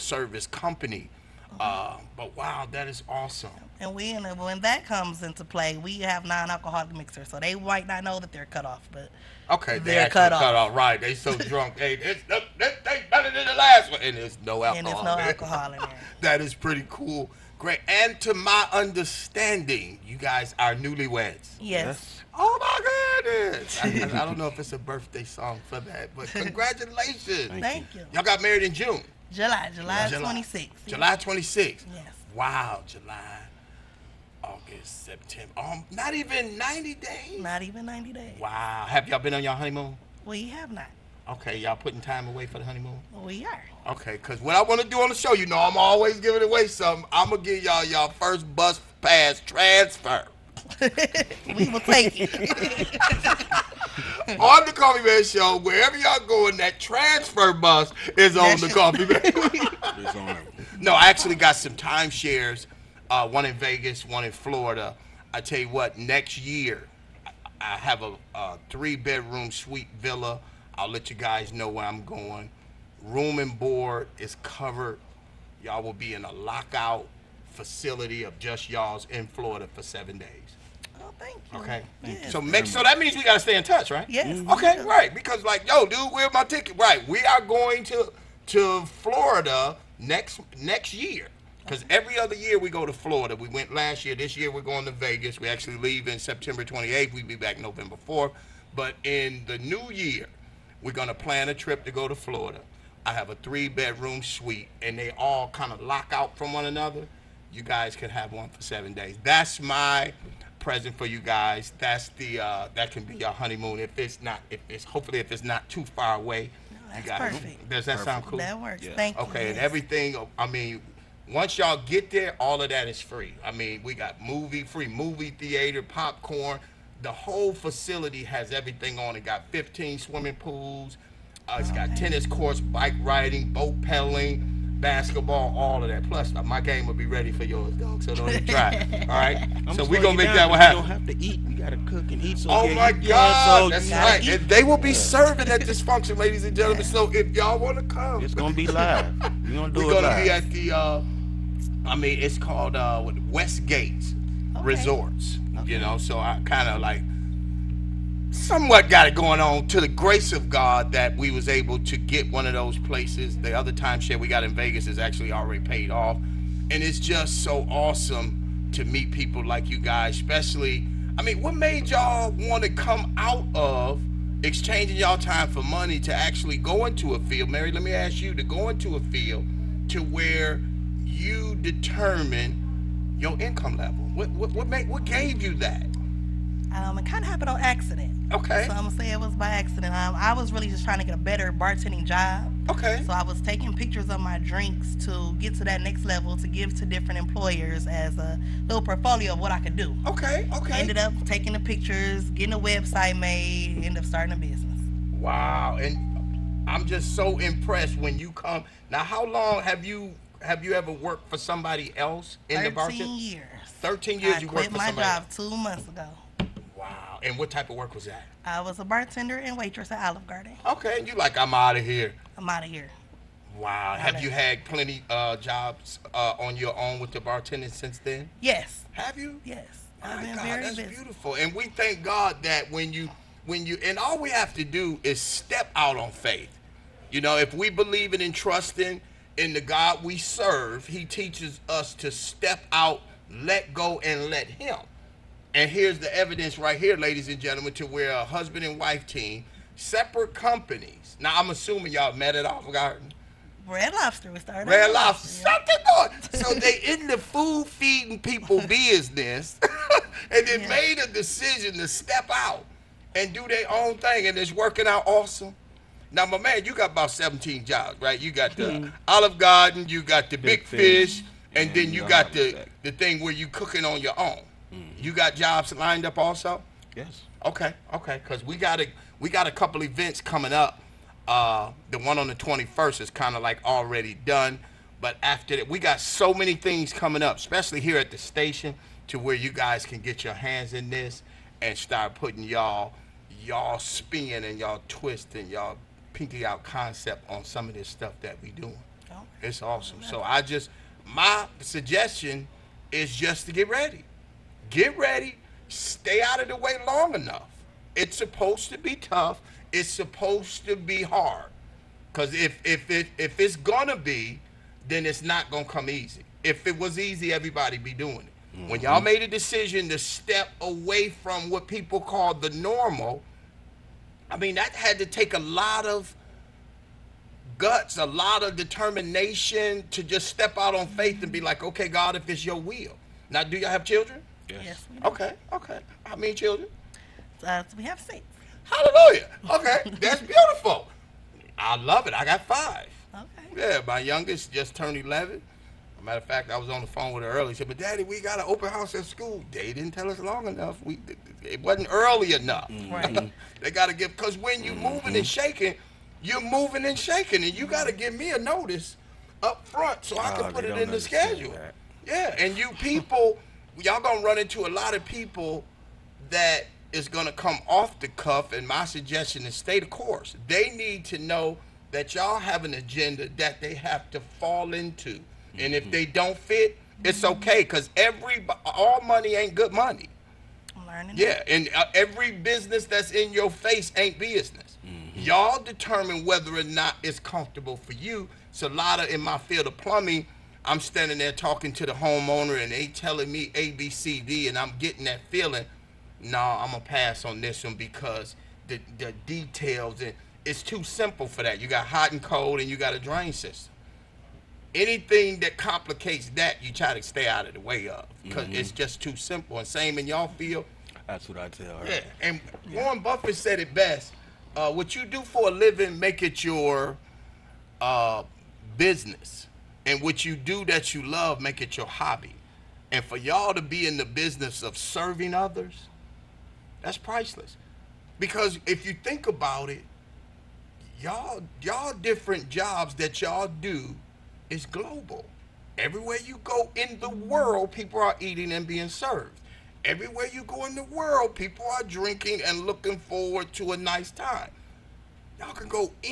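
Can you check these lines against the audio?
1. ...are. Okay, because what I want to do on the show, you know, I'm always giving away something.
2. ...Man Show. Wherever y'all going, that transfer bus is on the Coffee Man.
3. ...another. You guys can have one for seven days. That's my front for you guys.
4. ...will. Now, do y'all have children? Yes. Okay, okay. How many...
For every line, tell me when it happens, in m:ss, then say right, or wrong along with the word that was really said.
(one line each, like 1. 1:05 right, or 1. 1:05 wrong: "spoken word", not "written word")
1. 0:43 right
2. 0:55 right
3. 1:46 wrong: "present", not "front"
4. 5:32 right.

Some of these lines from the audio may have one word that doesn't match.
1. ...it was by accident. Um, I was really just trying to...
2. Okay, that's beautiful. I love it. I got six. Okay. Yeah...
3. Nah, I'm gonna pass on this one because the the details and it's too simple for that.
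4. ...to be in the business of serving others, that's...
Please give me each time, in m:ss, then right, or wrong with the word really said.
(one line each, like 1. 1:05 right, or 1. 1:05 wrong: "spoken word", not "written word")
1. 3:09 right
2. 5:39 wrong: "five", not "six"
3. 6:36 right
4. 7:03 right.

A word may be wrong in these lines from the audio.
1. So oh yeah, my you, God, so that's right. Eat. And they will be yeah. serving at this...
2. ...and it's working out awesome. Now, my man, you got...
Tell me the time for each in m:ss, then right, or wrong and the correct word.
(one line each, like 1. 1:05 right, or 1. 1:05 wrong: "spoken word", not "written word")
1. 2:22 right
2. 4:24 right.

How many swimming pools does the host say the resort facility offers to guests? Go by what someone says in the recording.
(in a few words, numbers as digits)
15.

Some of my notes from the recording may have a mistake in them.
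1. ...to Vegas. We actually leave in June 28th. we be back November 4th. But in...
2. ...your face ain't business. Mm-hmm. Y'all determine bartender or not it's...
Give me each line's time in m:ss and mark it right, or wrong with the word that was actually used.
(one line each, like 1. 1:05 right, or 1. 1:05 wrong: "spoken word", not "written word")
1. 1:34 wrong: "September", not "June"
2. 6:23 wrong: "whether", not "bartender".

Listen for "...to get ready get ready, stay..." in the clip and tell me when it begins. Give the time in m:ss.
5:03.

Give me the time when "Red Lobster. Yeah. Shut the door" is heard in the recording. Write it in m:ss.
4:14.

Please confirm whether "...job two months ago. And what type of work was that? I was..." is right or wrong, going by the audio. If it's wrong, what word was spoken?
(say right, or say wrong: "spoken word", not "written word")
right.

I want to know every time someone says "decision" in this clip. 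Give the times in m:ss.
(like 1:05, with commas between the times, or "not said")
4:21, 5:19.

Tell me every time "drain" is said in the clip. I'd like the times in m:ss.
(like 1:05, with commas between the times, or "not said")
6:42.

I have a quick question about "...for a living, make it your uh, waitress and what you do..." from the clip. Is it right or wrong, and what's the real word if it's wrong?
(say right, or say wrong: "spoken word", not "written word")
wrong: "business", not "waitress".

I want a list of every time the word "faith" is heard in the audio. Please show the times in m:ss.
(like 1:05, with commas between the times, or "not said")
3:56, 5:30.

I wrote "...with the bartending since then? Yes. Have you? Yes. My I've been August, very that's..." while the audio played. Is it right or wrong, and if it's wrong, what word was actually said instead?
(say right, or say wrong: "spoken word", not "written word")
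wrong: "God", not "August".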